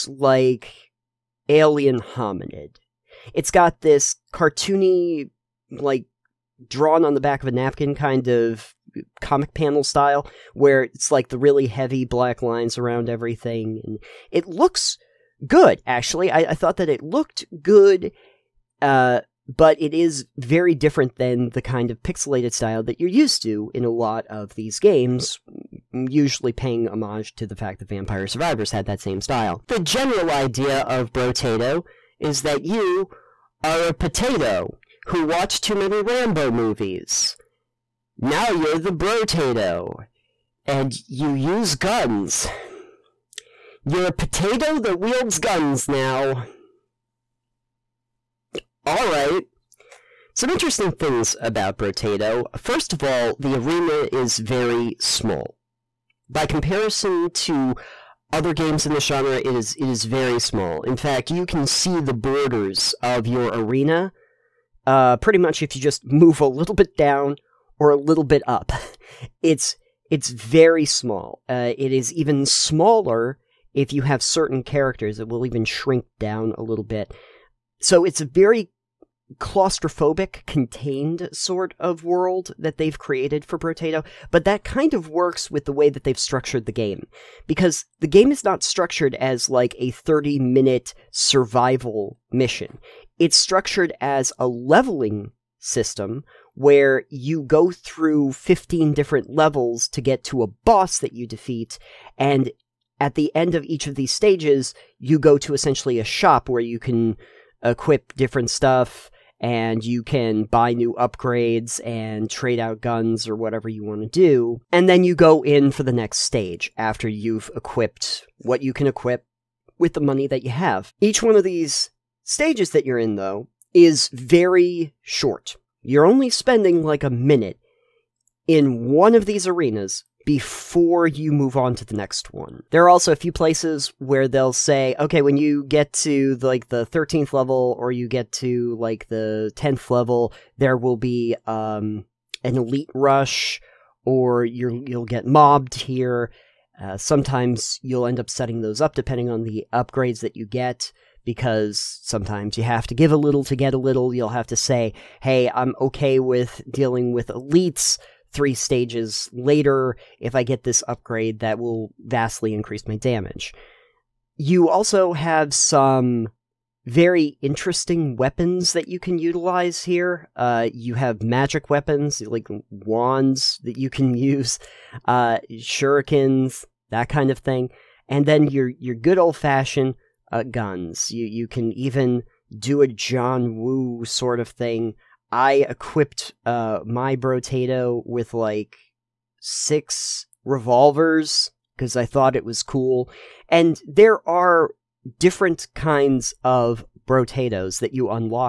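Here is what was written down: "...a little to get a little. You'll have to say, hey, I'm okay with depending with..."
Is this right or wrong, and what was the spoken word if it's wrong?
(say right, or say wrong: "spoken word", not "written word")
wrong: "dealing", not "depending".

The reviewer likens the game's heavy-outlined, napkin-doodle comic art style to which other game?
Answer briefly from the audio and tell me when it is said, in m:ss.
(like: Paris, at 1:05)
Alien Hominid, at 0:01.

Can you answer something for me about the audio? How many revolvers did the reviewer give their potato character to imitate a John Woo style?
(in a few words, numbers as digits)
6.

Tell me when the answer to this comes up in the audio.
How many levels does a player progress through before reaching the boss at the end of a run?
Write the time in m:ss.
1:38.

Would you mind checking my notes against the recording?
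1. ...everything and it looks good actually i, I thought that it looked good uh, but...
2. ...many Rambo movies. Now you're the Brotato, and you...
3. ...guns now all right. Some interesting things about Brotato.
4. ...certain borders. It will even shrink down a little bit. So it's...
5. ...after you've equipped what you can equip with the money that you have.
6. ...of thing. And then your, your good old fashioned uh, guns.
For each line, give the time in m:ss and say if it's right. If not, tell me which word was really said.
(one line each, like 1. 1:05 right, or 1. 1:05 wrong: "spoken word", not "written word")
1. 0:13 right
2. 0:35 right
3. 0:45 right
4. 1:14 wrong: "characters", not "borders"
5. 1:56 right
6. 2:57 right.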